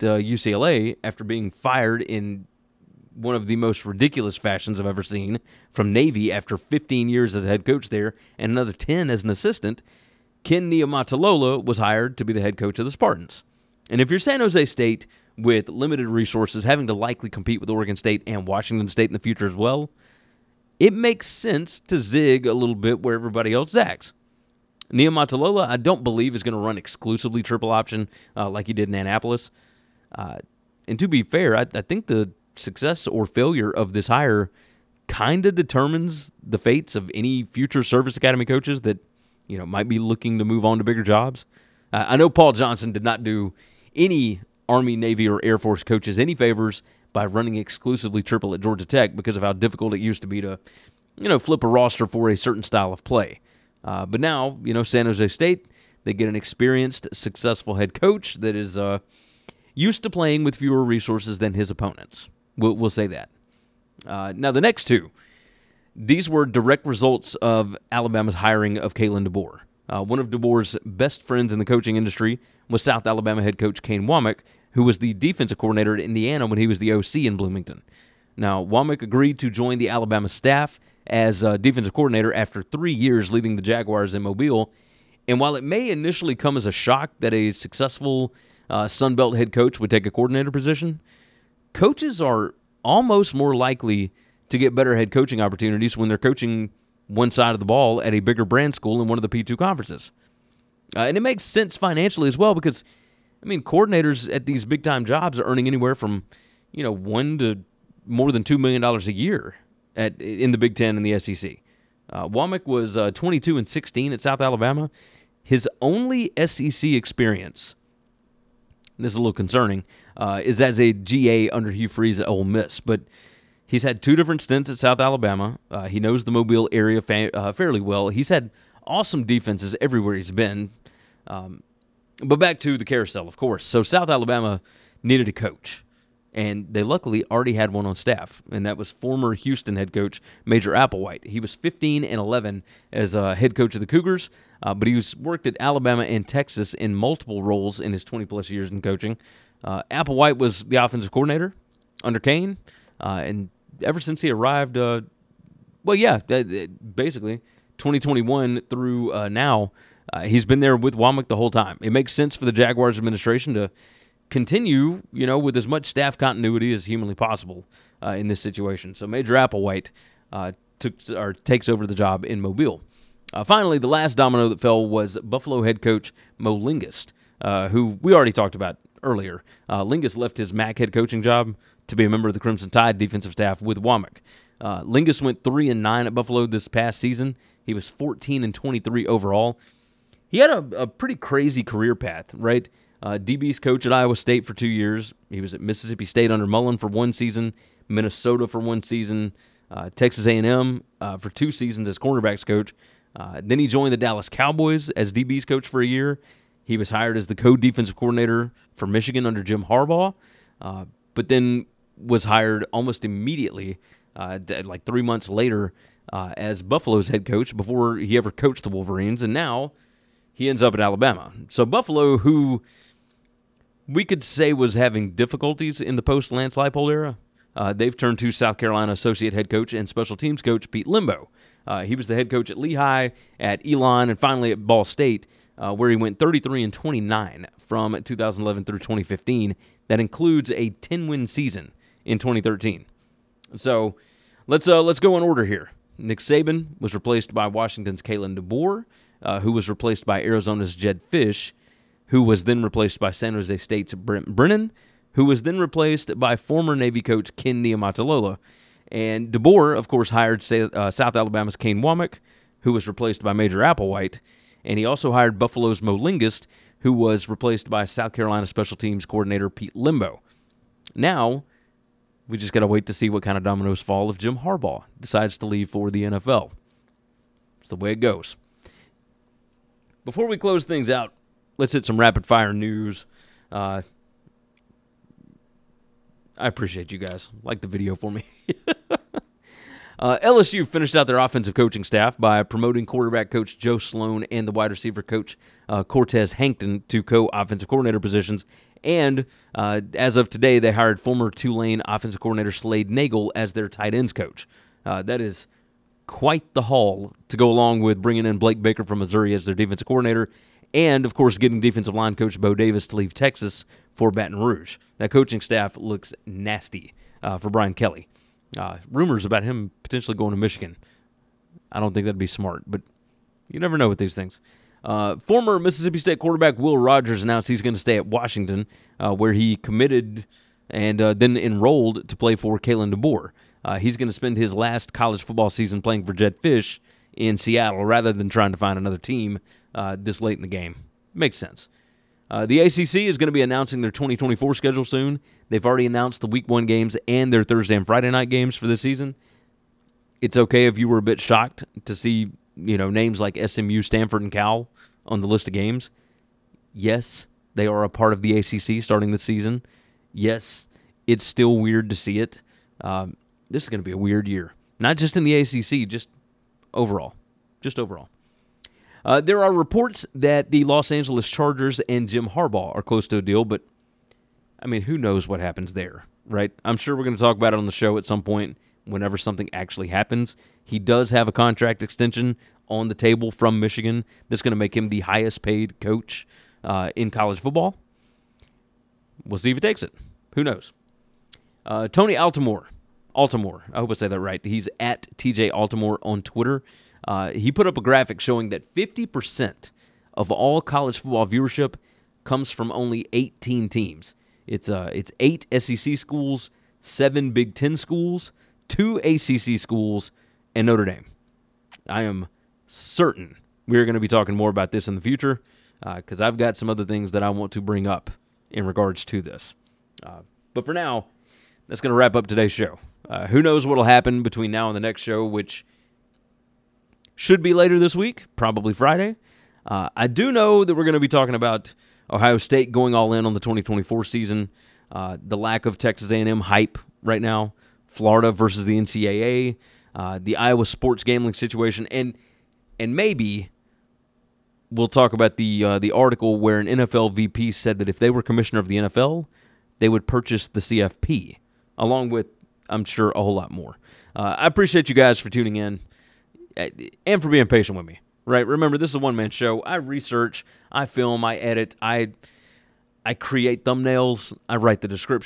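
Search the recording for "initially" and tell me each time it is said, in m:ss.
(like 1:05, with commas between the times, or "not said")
1:25.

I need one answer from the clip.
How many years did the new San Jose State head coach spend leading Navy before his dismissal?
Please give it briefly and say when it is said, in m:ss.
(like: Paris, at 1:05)
15, at 0:06.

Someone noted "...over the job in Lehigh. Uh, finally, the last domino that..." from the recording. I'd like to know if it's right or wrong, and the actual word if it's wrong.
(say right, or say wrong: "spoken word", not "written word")
wrong: "Mobile", not "Lehigh".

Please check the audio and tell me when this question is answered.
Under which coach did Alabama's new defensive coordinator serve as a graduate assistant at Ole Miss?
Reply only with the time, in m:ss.
2:01.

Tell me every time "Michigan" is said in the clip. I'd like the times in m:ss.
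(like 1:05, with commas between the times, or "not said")
3:28, 5:20, 6:23.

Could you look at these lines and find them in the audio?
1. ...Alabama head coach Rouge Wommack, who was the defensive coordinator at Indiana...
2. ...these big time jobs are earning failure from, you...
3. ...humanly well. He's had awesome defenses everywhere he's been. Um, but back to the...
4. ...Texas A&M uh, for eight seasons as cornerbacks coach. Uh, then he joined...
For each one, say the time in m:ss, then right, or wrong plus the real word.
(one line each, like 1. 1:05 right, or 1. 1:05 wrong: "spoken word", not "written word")
1. 1:13 wrong: "Kane", not "Rouge"
2. 1:44 wrong: "anywhere", not "failure"
3. 2:07 wrong: "fairly", not "humanly"
4. 3:19 wrong: "two", not "eight".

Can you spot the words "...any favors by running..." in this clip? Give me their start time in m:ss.
0:46.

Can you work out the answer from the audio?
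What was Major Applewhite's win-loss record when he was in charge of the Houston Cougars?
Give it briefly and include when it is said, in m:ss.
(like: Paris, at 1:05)
15 and 11, at 2:21.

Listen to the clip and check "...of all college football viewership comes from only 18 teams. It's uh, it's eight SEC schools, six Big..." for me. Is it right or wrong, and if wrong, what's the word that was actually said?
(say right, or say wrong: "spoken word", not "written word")
wrong: "seven", not "six".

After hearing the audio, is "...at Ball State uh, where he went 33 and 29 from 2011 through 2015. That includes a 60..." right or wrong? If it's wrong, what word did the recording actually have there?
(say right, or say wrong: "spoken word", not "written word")
wrong: "10", not "60".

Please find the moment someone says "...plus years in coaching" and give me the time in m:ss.
2:28.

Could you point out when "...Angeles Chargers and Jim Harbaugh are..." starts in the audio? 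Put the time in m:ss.
6:10.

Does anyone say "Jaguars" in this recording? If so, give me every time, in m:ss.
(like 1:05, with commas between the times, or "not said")
1:23, 2:42.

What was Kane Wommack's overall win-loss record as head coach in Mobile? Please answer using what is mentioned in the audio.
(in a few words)
22 and 16.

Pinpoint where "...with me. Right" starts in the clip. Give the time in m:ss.
7:37.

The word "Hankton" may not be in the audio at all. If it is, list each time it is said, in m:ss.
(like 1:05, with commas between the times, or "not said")
4:56.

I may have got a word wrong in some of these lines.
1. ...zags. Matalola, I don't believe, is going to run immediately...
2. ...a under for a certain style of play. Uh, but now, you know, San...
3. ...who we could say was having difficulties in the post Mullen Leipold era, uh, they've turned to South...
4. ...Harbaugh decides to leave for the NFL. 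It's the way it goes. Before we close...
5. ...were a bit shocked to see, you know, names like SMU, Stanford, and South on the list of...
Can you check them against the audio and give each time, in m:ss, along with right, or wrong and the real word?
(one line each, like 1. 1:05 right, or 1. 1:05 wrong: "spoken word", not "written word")
1. 0:23 wrong: "exclusively", not "immediately"
2. 0:51 wrong: "roster", not "under"
3. 3:42 wrong: "Lance", not "Mullen"
4. 4:34 right
5. 5:50 wrong: "Cal", not "South".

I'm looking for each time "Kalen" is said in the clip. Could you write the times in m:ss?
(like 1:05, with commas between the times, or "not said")
1:08, 4:08, 5:32.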